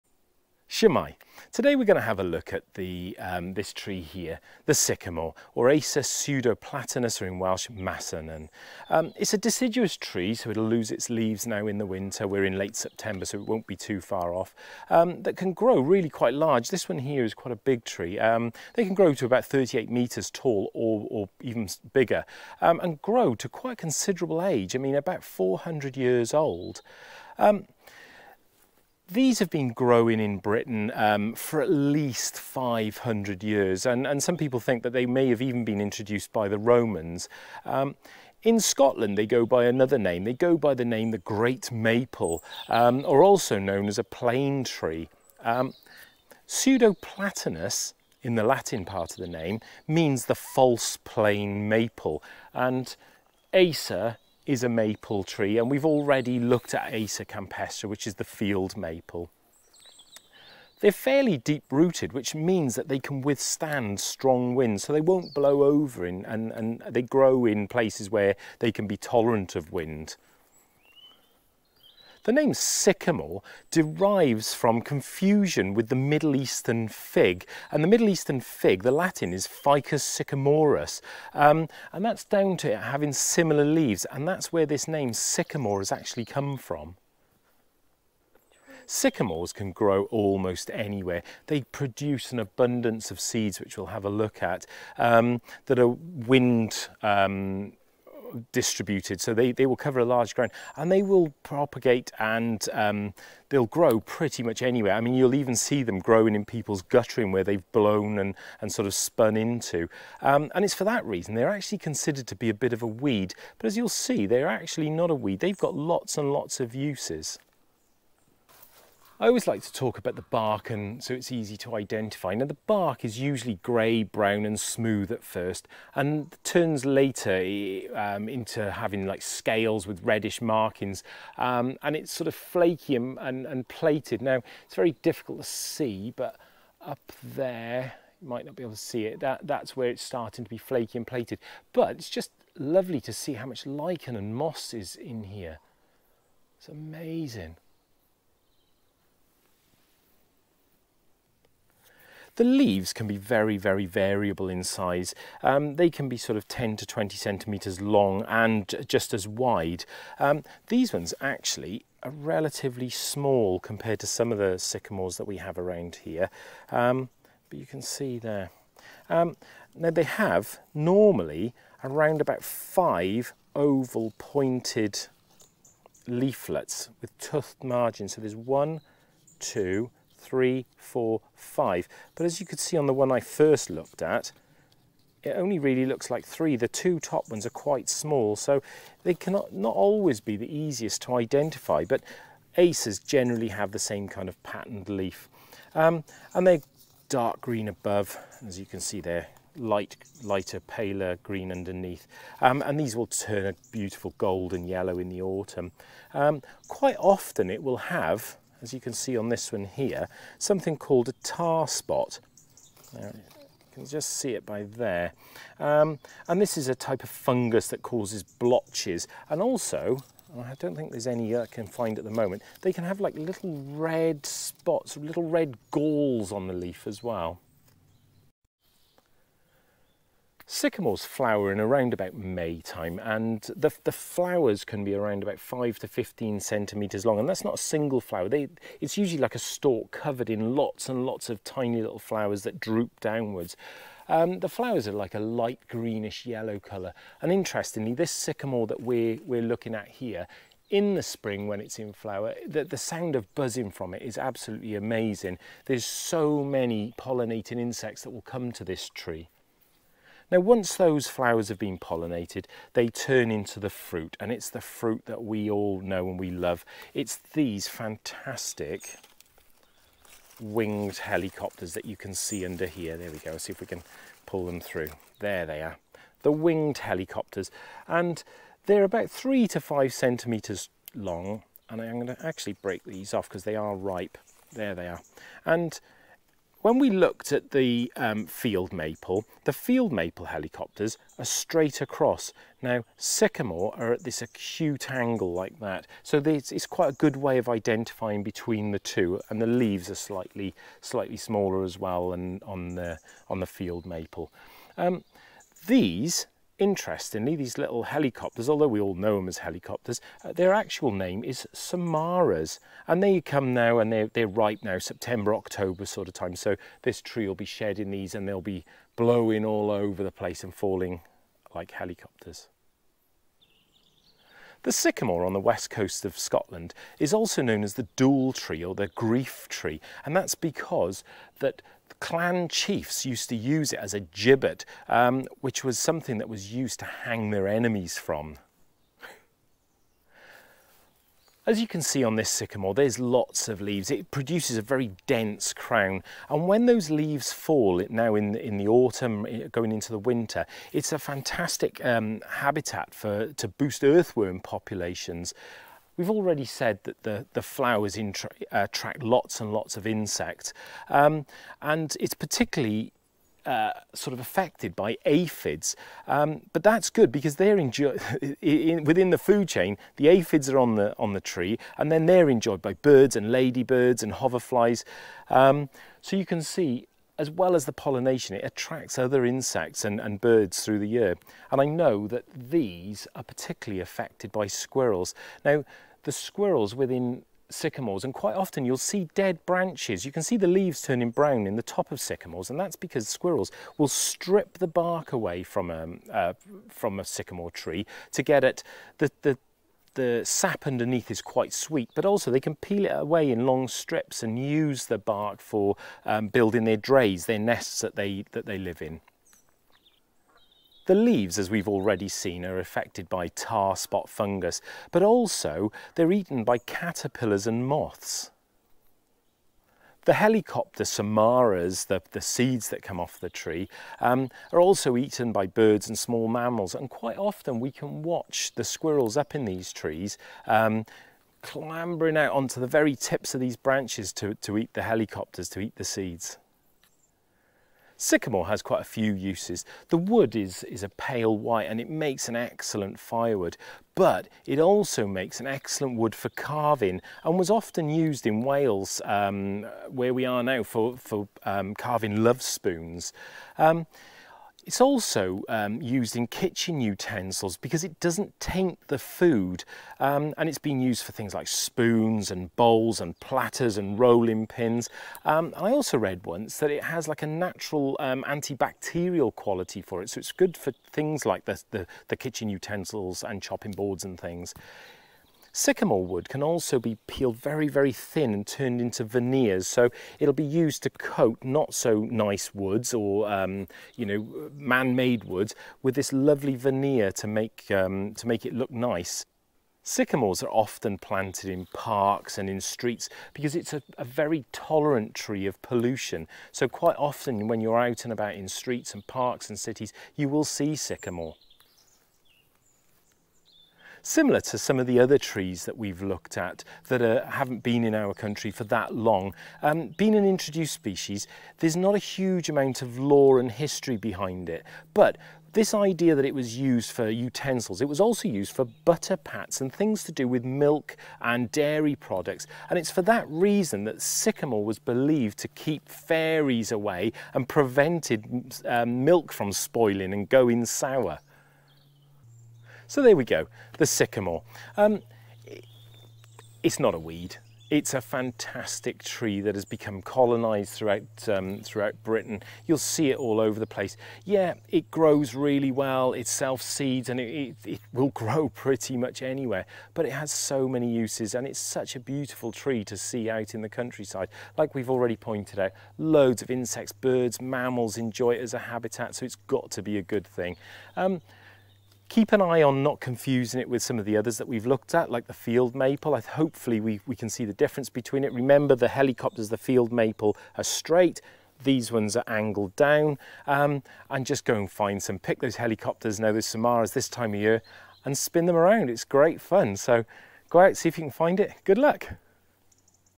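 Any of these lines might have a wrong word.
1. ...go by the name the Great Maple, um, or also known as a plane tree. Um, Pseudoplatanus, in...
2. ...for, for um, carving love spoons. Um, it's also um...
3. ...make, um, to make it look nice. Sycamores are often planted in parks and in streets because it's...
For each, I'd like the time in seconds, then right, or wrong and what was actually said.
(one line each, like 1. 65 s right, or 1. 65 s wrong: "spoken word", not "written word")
1. 40 s right
2. 450 s right
3. 487 s right.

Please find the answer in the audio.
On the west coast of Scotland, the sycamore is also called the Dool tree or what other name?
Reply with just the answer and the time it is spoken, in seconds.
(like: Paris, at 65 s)
Grief tree, at 328 s.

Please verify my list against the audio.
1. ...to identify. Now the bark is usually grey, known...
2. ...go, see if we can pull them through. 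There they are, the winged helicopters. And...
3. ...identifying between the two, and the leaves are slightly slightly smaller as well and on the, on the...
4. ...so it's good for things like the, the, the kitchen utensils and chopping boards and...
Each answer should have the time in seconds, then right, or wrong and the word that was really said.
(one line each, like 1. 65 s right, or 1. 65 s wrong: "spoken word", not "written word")
1. 121 s wrong: "brown", not "known"
2. 273 s right
3. 297 s right
4. 470 s right.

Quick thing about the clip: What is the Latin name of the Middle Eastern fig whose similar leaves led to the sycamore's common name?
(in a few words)
Ficus sycamorus.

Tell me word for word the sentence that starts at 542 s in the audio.
You'll see it all over the place.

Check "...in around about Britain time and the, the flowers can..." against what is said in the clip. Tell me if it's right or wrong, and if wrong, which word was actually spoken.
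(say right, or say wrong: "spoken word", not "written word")
wrong: "May", not "Britain".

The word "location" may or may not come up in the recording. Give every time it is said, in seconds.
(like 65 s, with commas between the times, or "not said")
not said.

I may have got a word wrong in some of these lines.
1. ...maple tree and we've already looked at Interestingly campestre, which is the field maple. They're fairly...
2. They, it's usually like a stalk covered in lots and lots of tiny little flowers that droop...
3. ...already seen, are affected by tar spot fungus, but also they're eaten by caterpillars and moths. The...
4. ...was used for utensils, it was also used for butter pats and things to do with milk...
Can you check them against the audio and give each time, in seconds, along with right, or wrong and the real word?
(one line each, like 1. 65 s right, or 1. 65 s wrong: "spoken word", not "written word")
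1. 54 s wrong: "Acer", not "Interestingly"
2. 238 s right
3. 411 s right
4. 516 s right.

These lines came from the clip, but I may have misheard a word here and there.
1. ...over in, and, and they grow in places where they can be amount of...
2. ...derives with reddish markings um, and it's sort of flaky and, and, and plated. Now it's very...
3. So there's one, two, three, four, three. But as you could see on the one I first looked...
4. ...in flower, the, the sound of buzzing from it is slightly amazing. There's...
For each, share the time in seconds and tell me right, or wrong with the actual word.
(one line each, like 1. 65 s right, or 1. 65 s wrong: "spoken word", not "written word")
1. 65 s wrong: "tolerant", not "amount"
2. 129 s wrong: "scales", not "derives"
3. 178 s wrong: "five", not "three"
4. 251 s wrong: "absolutely", not "slightly".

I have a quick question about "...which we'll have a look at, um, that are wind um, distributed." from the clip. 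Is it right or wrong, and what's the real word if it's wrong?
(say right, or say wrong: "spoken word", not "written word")
right.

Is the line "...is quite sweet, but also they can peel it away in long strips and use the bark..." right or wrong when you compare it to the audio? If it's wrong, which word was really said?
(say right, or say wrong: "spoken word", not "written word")
right.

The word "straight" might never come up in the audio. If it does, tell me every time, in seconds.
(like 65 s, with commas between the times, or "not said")
291 s, 570 s.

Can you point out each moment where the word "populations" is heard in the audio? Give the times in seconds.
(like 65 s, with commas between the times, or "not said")
354 s.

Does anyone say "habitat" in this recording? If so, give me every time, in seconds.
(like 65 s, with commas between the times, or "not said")
352 s, 558 s.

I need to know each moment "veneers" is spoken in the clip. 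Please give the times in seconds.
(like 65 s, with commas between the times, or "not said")
479 s, 486 s.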